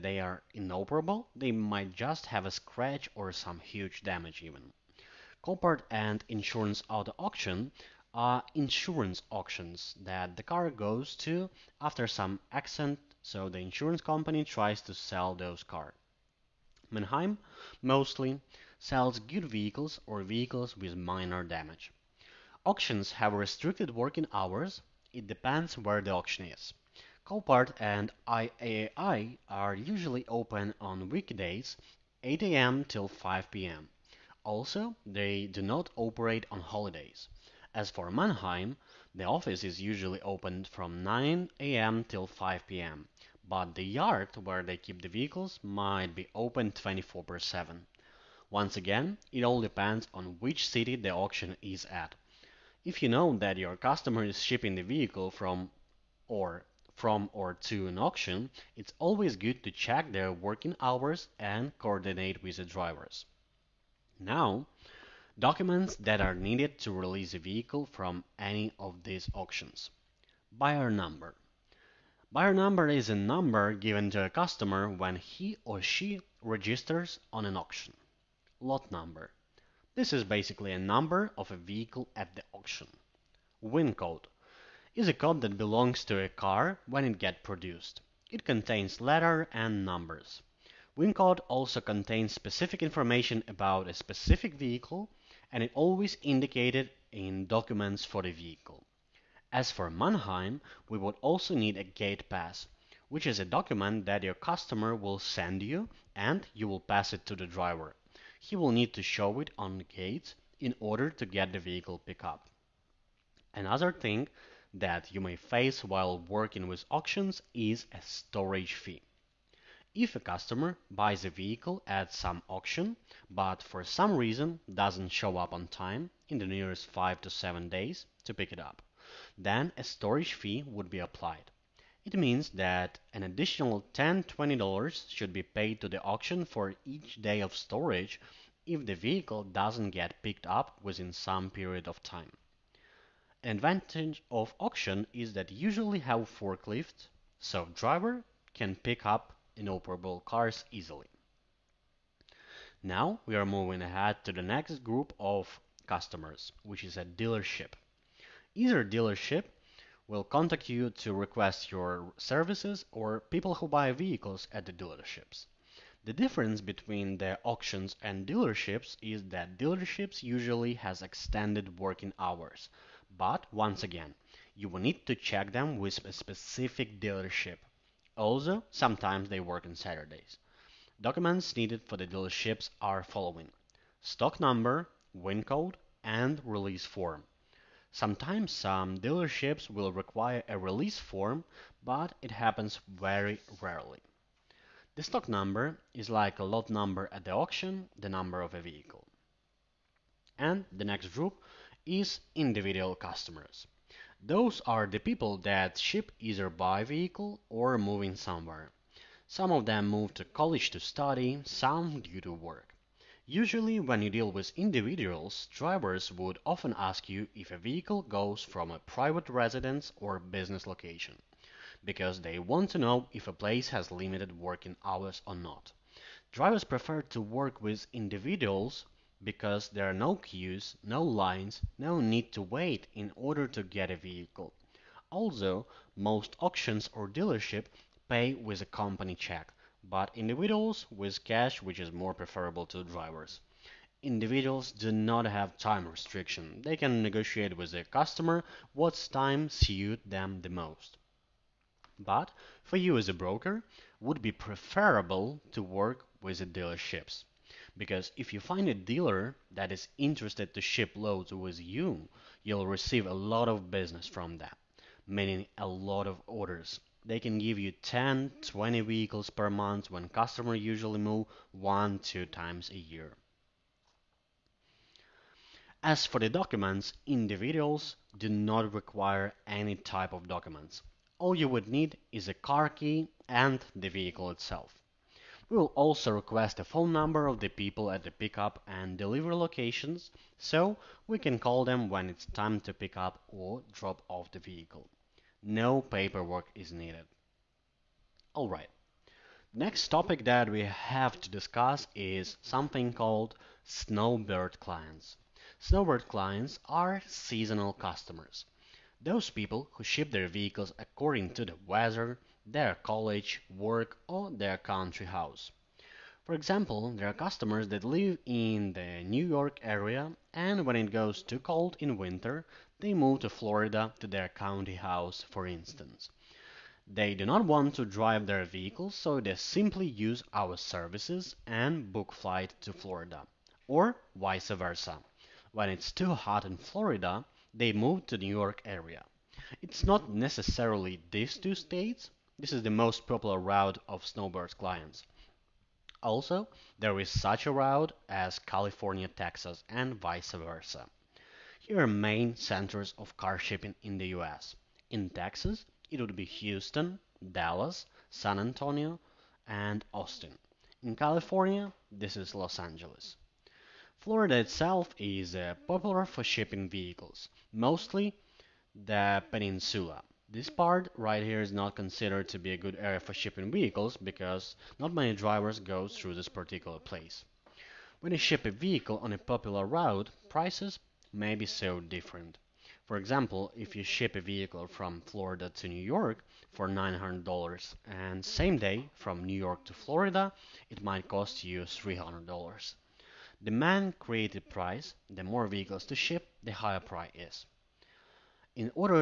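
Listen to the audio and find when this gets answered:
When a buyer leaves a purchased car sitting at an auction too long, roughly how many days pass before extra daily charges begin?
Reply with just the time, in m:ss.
2:06.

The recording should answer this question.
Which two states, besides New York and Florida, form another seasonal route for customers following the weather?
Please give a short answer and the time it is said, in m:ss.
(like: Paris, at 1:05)
California, Texas, at 5:48.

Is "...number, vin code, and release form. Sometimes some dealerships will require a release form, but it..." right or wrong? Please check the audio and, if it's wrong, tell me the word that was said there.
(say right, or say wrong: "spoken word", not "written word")
right.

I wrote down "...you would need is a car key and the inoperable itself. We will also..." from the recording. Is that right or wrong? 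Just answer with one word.
wrong.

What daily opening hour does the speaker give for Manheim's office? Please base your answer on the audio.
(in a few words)
9 a.m.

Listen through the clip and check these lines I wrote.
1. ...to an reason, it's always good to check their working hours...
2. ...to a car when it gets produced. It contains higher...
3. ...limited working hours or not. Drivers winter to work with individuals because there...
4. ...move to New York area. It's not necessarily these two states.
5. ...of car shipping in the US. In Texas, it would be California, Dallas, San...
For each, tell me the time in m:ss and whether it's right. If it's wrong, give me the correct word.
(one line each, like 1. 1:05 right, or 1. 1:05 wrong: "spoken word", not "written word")
1. 0:57 wrong: "auction", not "reason"
2. 1:26 wrong: "letter", not "higher"
3. 3:43 wrong: "prefer", not "winter"
4. 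5:37 right
5. 5:52 wrong: "Houston", not "California".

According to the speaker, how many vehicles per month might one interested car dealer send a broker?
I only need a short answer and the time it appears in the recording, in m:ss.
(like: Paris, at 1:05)
10, 20, at 4:27.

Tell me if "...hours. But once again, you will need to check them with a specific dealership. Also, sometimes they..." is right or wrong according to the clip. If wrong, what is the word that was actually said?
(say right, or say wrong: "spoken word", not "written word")
right.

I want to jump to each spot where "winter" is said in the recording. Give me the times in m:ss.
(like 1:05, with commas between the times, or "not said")
5:21.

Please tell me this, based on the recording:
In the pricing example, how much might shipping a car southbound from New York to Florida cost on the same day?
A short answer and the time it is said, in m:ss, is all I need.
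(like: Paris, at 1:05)
$300, at 6:31.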